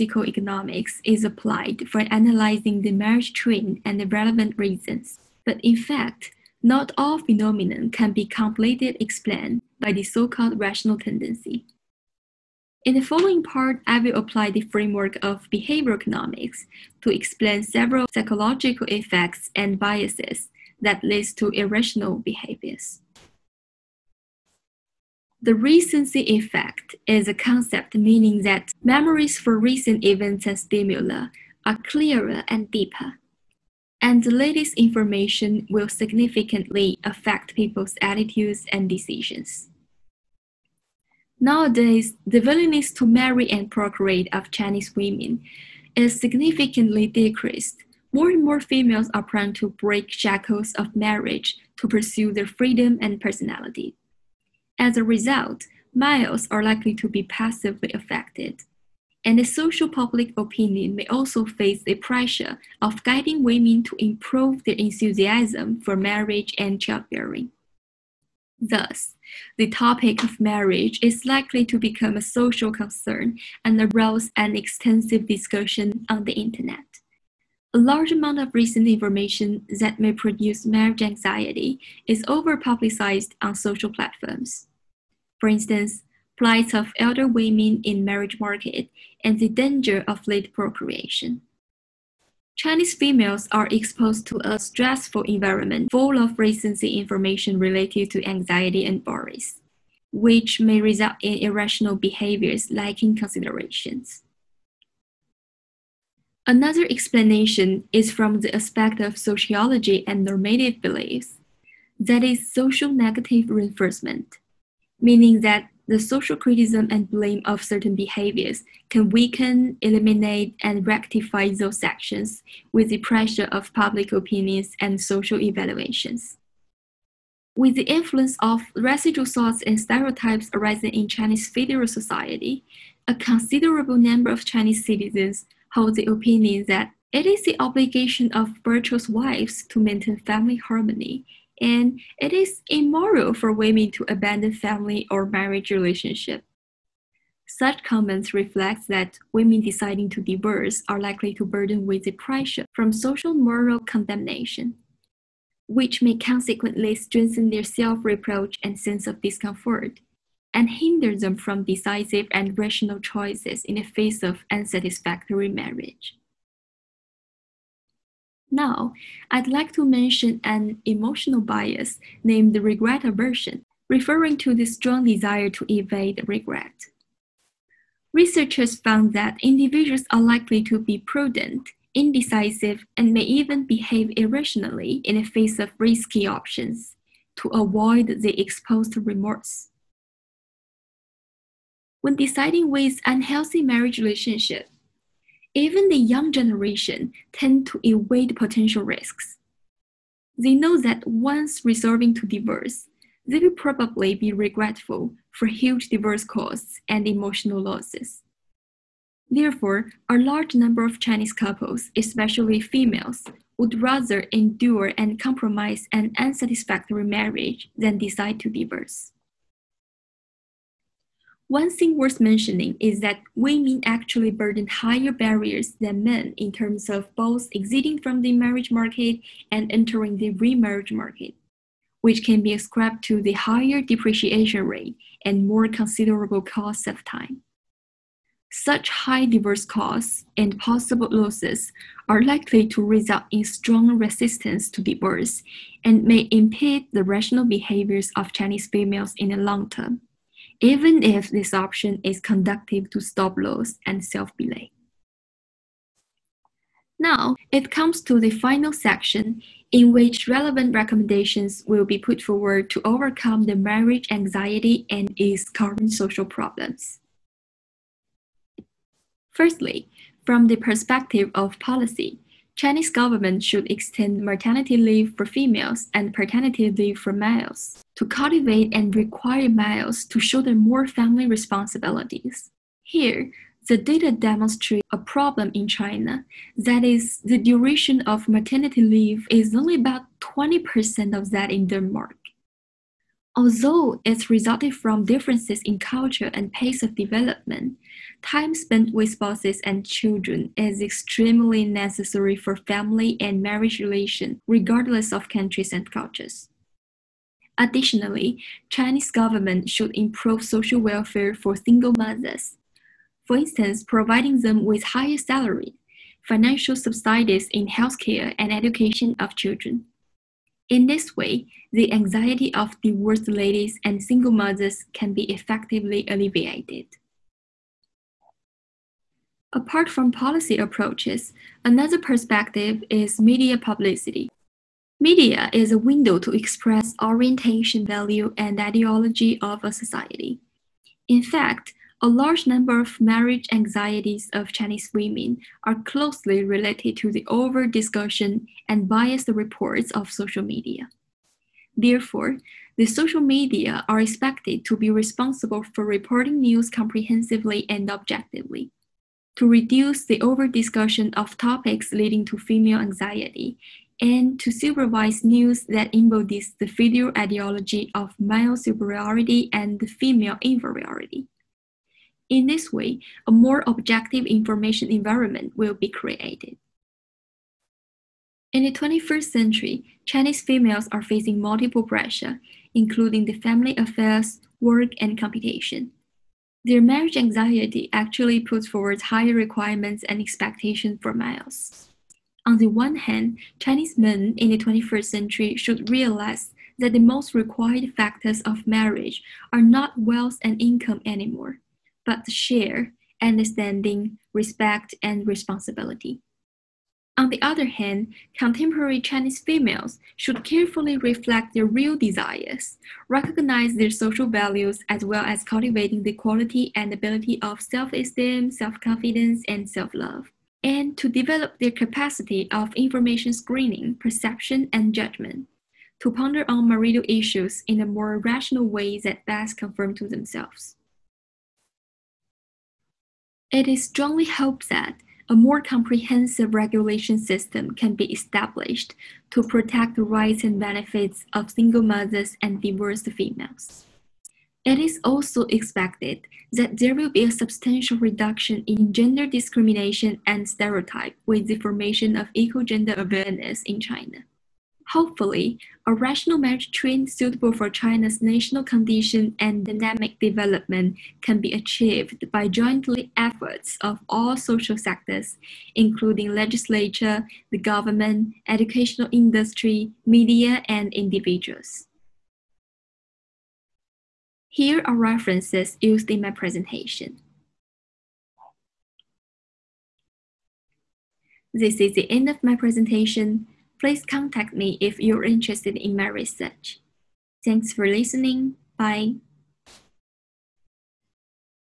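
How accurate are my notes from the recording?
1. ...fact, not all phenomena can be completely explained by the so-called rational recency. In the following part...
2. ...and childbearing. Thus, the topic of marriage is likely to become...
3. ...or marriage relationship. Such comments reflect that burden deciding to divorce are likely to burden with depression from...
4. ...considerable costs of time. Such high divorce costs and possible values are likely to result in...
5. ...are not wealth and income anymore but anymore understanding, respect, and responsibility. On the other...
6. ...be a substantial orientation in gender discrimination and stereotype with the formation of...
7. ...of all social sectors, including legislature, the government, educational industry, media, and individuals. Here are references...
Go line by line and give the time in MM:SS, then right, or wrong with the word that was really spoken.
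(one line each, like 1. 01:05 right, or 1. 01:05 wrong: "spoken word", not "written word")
1. 00:05 wrong: "tendency", not "recency"
2. 01:06 right
3. 02:25 wrong: "women", not "burden"
4. 03:55 wrong: "losses", not "values"
5. 06:39 wrong: "share", not "anymore"
6. 07:27 wrong: "reduction", not "orientation"
7. 07:43 right.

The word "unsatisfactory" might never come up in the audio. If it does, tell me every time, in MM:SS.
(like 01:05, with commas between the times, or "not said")
02:44, 03:36.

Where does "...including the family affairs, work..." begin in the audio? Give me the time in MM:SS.
06:22.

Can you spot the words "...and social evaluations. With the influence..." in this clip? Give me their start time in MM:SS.
02:04.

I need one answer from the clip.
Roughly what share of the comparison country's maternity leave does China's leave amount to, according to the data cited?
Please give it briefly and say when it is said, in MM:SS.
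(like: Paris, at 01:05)
20%, at 04:50.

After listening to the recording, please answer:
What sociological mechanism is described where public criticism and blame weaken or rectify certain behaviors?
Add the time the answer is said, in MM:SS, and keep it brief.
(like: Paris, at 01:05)
Social negative reinforcement, at 01:52.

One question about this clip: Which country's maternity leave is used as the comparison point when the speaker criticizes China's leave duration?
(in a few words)
Denmark.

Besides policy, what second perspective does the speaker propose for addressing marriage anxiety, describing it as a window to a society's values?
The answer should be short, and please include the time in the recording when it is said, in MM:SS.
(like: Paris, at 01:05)
Media publicity, at 05:33.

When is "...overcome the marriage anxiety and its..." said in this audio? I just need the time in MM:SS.
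04:22.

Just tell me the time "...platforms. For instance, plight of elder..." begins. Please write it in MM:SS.
01:23.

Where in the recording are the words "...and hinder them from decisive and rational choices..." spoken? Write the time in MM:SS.
02:40.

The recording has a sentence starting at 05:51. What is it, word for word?
Therefore, the social media are expected to be responsible for reporting news comprehensively and objectively.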